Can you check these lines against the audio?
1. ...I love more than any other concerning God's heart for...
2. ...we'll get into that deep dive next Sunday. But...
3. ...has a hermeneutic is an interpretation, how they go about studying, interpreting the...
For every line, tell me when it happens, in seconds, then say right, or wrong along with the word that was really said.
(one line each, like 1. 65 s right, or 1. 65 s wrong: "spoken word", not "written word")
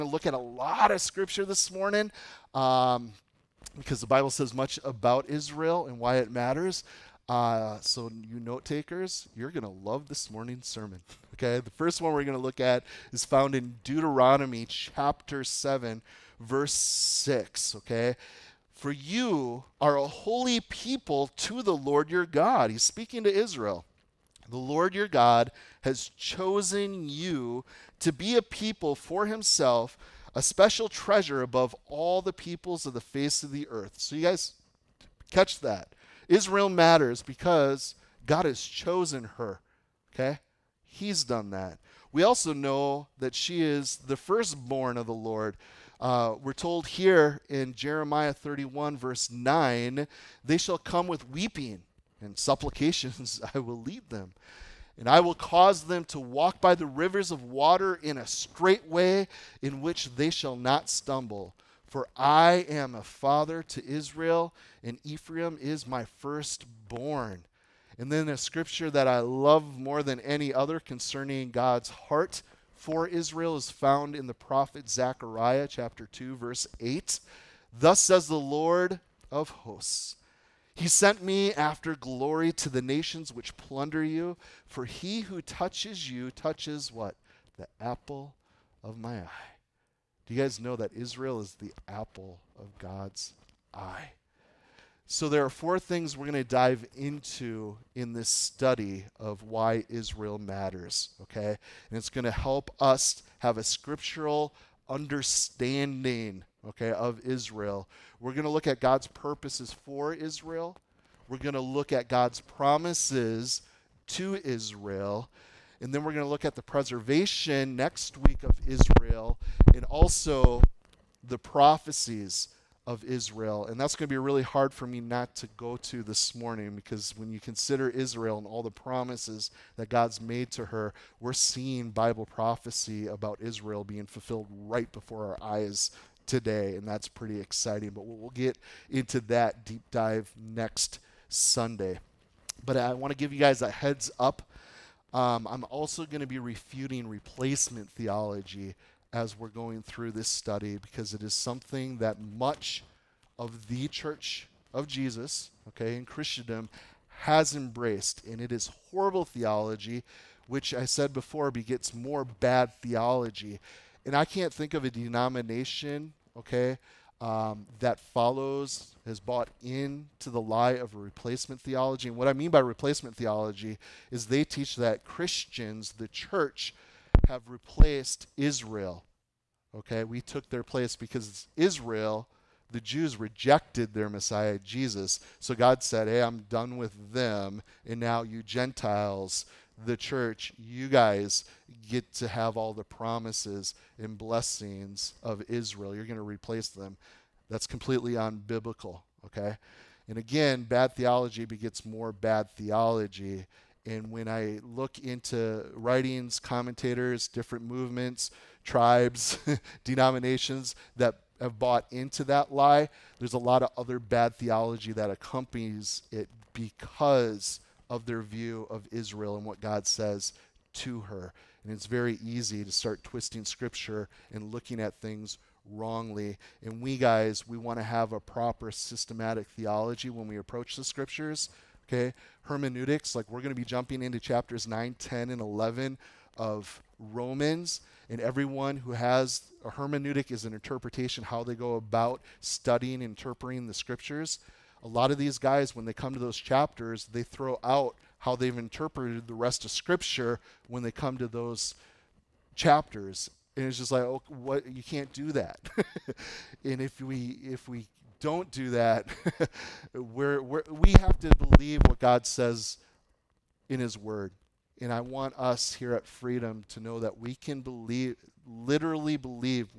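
1. 69 s right
2. 138 s right
3. 238 s right.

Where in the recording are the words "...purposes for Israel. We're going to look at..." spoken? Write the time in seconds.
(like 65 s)
109 s.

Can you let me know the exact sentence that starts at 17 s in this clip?
Okay, for you are a holy people to the Lord your God.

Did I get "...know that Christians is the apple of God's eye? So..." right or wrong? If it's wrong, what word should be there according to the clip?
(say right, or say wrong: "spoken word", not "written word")
wrong: "Israel", not "Christians".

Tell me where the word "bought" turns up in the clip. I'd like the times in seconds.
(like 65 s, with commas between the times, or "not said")
169 s, 211 s.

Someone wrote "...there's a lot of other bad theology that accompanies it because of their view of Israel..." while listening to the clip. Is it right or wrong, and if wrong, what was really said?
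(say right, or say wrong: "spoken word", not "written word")
right.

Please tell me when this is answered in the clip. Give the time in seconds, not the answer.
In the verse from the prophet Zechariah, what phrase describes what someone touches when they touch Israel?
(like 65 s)
87 s.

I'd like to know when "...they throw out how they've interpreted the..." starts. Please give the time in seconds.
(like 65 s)
247 s.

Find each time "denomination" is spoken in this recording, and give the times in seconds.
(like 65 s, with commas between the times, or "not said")
164 s, 209 s.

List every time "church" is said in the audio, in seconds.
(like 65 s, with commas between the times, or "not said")
153 s, 176 s, 189 s.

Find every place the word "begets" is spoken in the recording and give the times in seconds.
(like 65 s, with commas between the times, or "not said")
161 s, 201 s.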